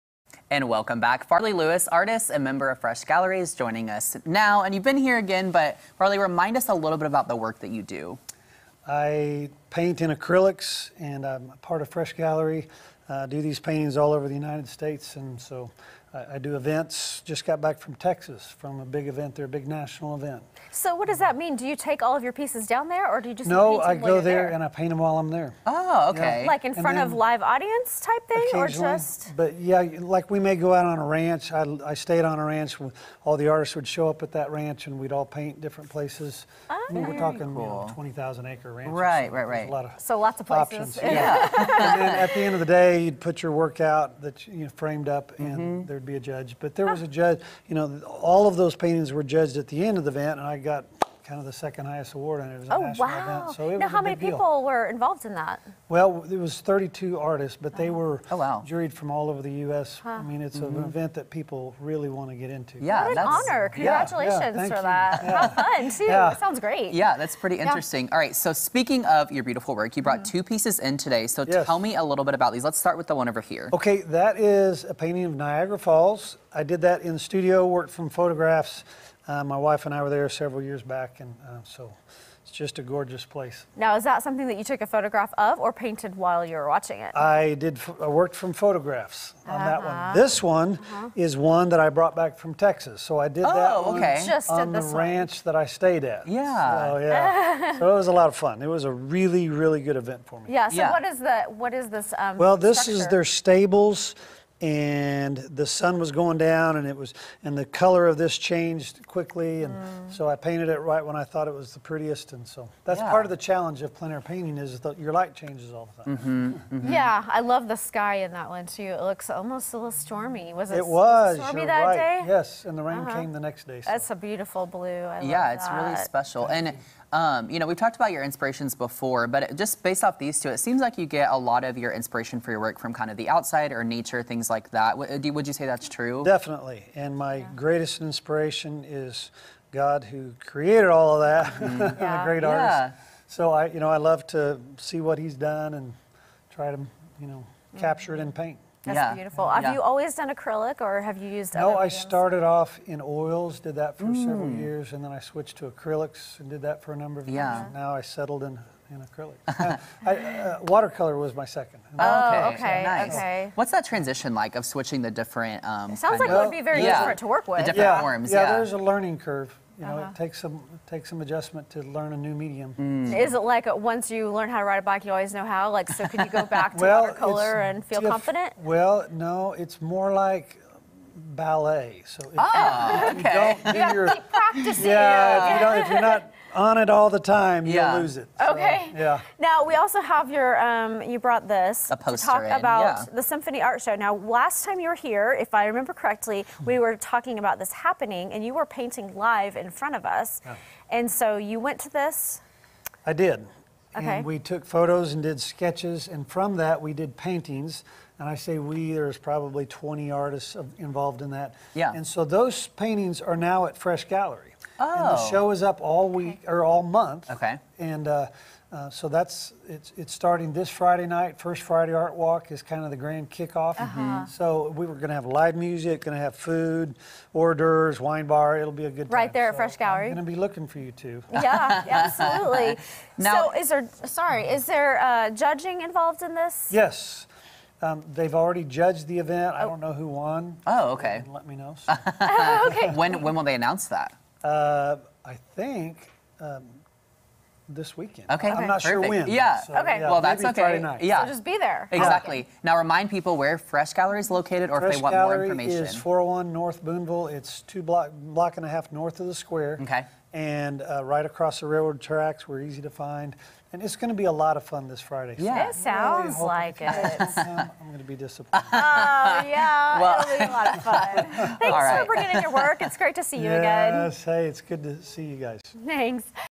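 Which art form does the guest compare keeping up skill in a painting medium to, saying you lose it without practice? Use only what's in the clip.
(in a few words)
Ballet.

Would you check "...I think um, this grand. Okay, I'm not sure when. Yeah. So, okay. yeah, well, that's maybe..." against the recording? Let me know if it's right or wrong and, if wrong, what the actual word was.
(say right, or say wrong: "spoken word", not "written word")
wrong: "weekend", not "grand".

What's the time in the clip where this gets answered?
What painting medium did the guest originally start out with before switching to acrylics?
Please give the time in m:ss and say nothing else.
2:32.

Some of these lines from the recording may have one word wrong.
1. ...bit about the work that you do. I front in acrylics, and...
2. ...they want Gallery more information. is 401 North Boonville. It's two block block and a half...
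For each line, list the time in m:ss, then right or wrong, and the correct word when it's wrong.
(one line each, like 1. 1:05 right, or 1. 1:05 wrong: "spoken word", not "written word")
1. 0:06 wrong: "paint", not "front"
2. 4:14 right.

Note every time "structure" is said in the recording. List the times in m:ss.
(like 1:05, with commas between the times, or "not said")
1:42.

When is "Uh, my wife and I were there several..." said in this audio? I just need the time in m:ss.
1:19.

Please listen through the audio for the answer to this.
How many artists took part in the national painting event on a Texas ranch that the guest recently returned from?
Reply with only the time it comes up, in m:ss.
0:56.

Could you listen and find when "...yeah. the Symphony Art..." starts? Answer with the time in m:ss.
3:13.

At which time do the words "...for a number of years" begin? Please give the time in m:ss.
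2:36.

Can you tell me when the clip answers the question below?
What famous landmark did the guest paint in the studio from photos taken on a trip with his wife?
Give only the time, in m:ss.
1:15.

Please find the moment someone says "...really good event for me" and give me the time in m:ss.
1:39.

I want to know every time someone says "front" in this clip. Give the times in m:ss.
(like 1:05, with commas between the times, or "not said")
0:26, 3:19.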